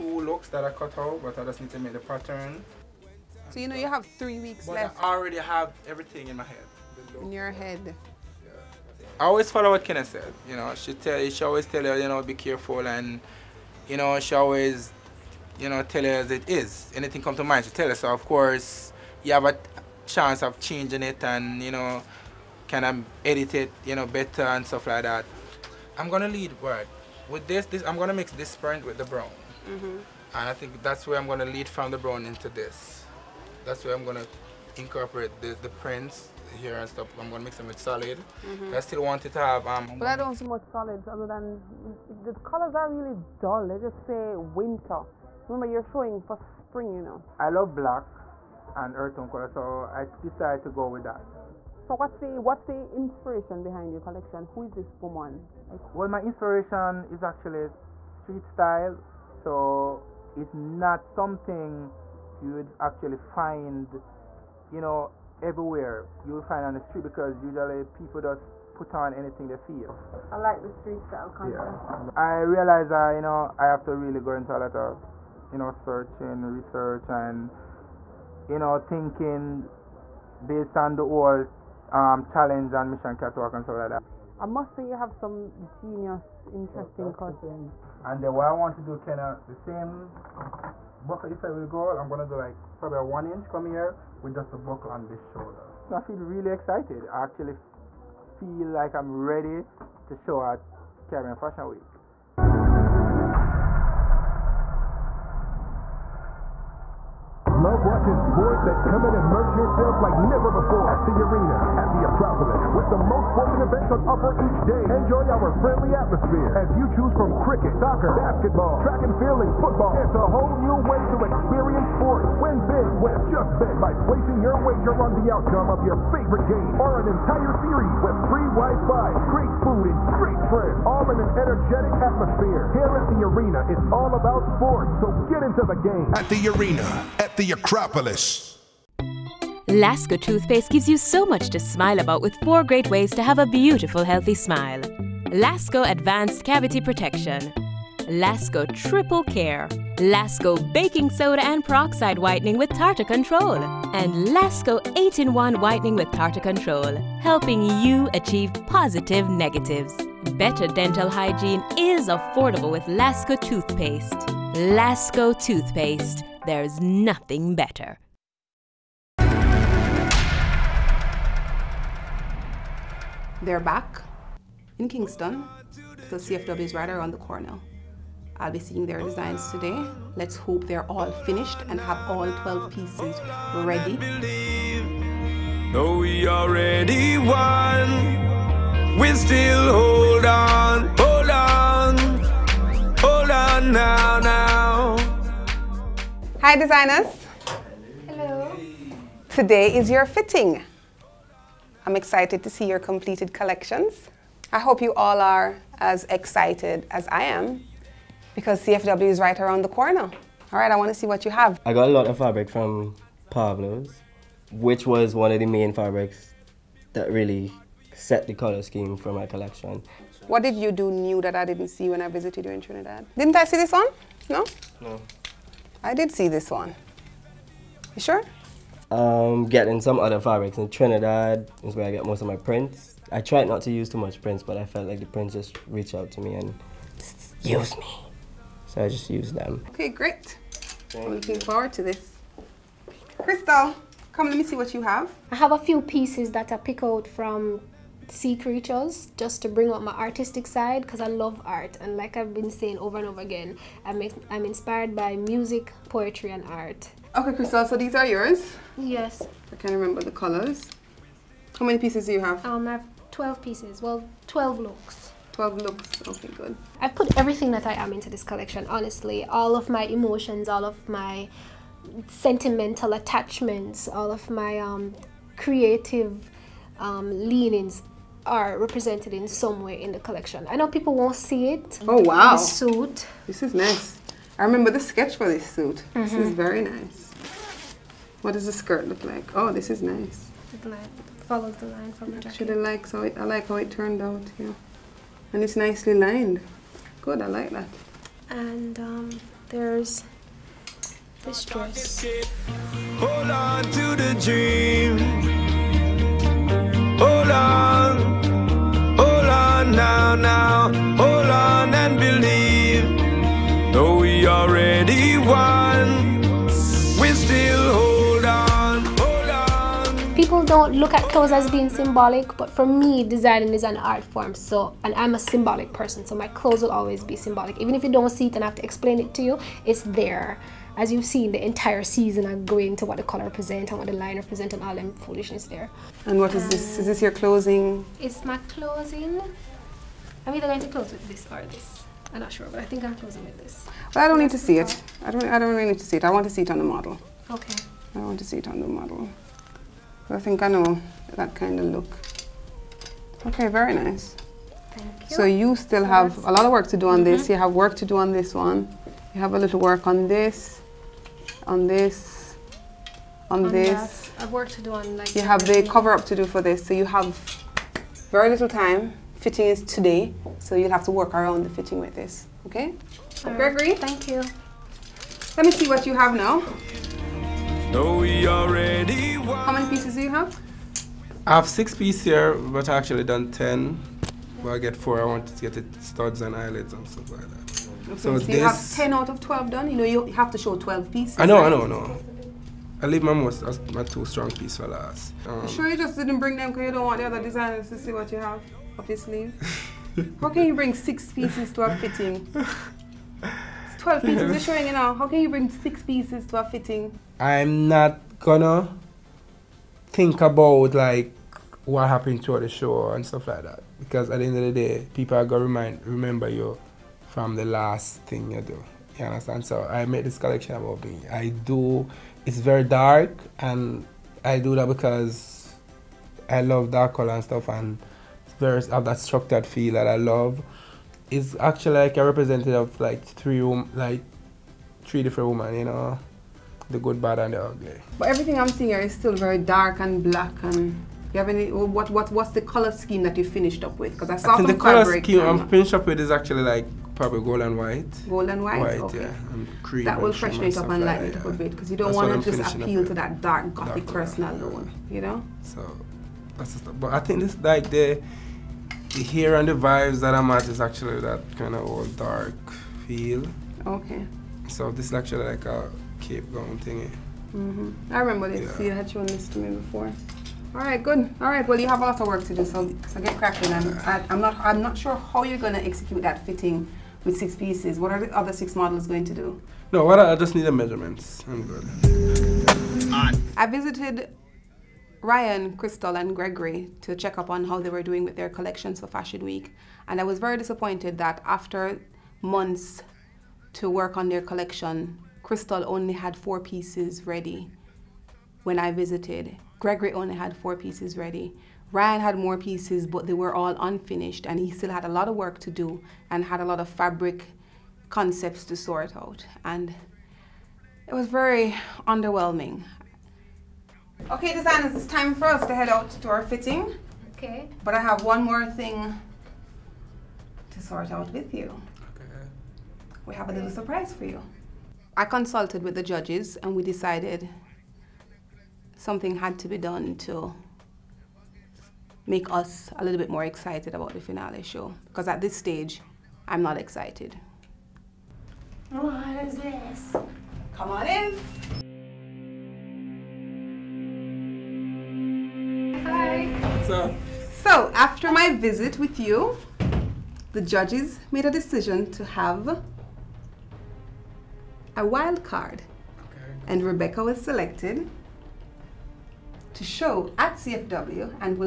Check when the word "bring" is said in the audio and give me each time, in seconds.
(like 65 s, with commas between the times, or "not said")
249 s, 396 s, 400 s, 405 s.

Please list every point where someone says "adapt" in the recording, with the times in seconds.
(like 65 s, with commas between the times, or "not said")
not said.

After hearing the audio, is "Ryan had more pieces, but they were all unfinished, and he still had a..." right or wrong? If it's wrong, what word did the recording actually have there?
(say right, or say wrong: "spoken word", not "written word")
right.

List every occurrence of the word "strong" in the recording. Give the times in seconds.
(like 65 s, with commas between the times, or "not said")
394 s.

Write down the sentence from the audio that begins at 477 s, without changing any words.
What are the other six models going to do?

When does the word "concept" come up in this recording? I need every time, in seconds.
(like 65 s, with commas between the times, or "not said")
71 s, 507 s.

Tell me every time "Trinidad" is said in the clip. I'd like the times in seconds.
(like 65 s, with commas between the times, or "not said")
222 s, 230 s.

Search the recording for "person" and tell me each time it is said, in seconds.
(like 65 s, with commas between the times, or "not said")
325 s, 453 s.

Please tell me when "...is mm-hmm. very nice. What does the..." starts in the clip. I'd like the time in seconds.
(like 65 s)
286 s.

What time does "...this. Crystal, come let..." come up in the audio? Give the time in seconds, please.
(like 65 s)
241 s.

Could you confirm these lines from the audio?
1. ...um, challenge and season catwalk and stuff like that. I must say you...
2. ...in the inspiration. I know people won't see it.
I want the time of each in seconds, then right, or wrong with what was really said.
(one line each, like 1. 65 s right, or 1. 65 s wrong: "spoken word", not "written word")
1. 81 s wrong: "mission", not "season"
2. 279 s wrong: "collection", not "inspiration".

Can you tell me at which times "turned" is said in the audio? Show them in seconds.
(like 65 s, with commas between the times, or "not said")
293 s.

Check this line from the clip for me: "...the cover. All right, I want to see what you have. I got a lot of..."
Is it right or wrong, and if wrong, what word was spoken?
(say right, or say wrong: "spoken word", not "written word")
wrong: "corner", not "cover".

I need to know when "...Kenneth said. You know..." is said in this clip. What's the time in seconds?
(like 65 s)
9 s.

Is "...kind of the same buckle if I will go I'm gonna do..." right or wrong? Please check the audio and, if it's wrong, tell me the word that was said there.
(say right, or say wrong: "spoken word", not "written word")
right.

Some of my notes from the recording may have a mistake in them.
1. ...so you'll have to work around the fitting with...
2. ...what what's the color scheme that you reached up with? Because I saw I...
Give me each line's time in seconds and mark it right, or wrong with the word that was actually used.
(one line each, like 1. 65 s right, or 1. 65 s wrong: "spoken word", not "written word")
1. 370 s right
2. 441 s wrong: "finished", not "reached".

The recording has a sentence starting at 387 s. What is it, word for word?
Okay, so, so you have ten out of twelve done.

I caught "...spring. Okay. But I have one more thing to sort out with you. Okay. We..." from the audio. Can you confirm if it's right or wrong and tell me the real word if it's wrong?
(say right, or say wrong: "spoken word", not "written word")
wrong: "fitting", not "spring".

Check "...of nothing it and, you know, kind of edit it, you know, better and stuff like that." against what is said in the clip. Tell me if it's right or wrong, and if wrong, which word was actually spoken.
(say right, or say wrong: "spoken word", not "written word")
wrong: "changing", not "nothing".